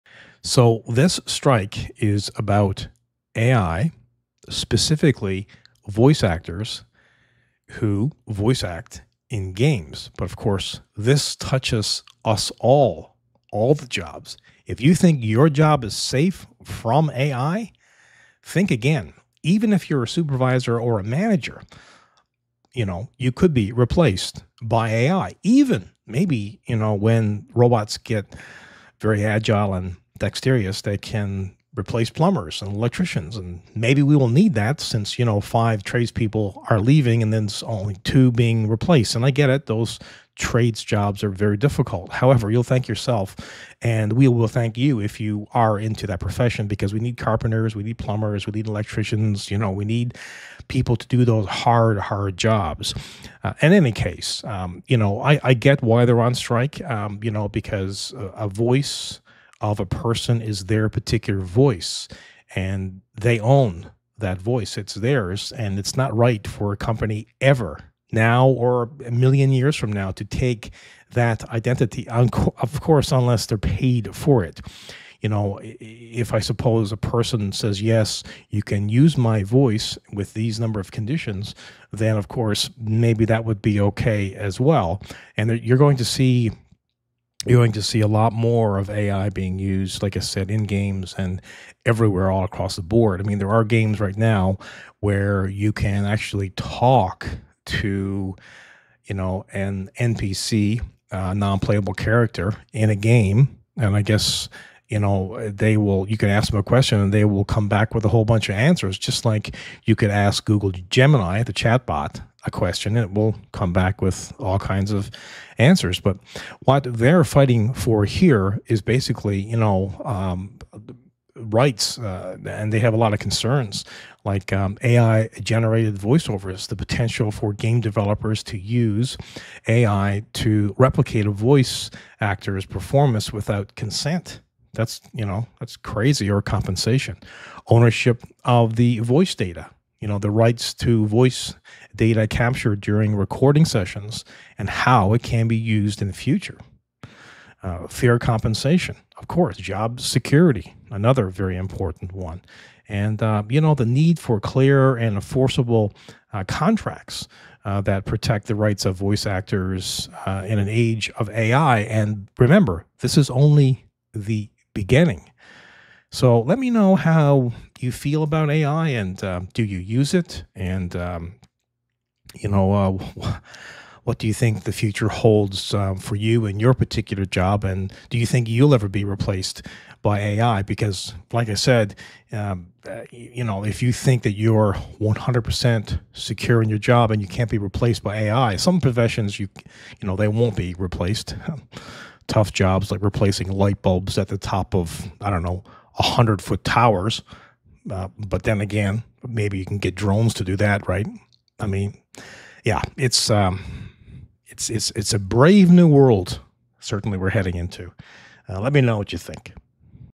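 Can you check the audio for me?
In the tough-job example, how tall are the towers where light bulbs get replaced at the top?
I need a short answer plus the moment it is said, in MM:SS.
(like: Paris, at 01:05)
100 feet, at 03:15.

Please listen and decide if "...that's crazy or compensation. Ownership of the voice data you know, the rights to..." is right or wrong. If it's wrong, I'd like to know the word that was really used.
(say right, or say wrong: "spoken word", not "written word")
right.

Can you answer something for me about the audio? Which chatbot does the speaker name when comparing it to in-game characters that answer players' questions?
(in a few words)
Google Gemini.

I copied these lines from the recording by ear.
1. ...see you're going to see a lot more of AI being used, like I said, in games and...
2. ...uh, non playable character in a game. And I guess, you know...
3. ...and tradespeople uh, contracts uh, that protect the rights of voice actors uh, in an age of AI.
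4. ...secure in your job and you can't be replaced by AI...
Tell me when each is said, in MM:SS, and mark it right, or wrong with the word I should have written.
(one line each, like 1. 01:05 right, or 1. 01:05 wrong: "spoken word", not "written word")
1. 01:26 right
2. 01:41 right
3. 02:34 wrong: "enforceable", not "tradespeople"
4. 03:06 right.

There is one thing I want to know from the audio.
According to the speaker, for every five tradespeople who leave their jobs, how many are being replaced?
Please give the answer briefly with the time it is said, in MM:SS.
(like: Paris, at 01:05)
2, at 00:38.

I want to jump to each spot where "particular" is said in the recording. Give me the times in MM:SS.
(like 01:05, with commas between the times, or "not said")
01:00, 02:56.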